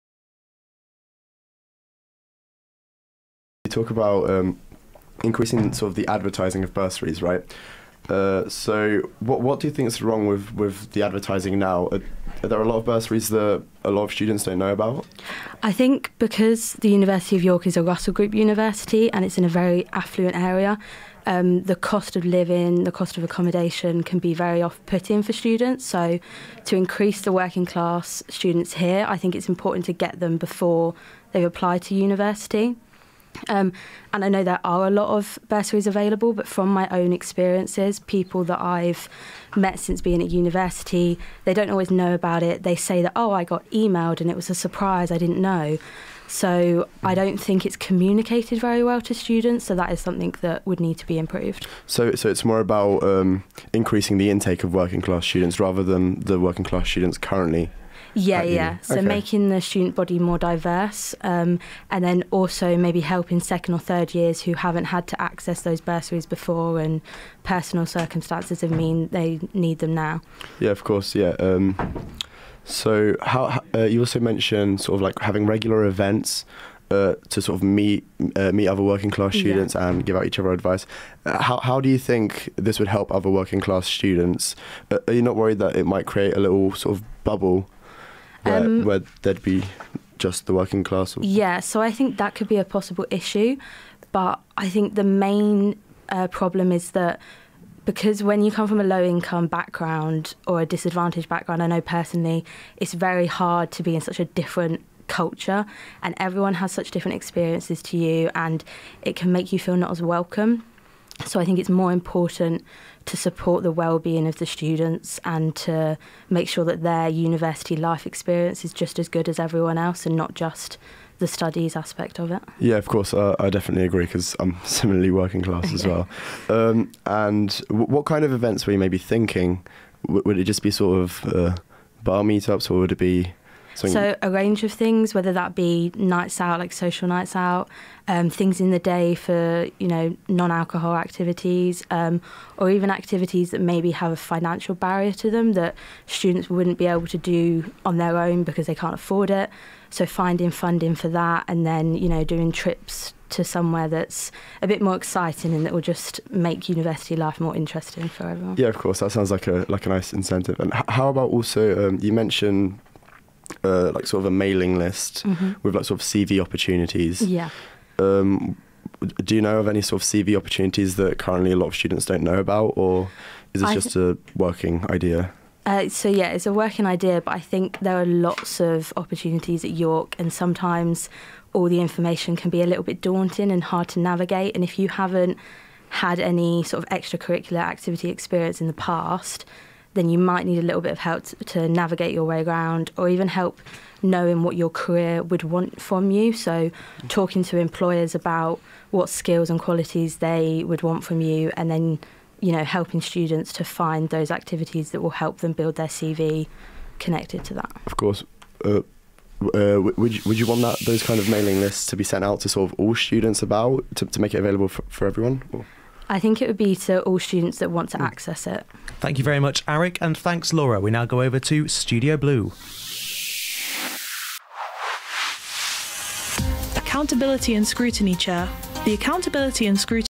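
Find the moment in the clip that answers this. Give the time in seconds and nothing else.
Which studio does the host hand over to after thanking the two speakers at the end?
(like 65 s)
221 s.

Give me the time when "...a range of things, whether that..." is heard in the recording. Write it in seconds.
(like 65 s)
134 s.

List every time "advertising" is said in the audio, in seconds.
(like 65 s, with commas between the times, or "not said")
6 s, 11 s.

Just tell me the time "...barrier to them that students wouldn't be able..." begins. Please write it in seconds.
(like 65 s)
144 s.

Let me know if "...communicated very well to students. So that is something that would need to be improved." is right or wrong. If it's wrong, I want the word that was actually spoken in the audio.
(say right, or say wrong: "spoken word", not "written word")
right.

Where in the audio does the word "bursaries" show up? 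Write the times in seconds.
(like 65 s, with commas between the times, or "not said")
6 s, 12 s, 35 s, 65 s.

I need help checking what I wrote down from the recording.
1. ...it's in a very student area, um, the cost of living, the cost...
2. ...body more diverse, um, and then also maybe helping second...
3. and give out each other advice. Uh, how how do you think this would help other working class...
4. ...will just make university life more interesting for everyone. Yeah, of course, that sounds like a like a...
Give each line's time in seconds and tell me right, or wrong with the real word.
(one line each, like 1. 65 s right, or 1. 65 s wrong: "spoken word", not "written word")
1. 19 s wrong: "affluent", not "student"
2. 59 s right
3. 79 s right
4. 155 s right.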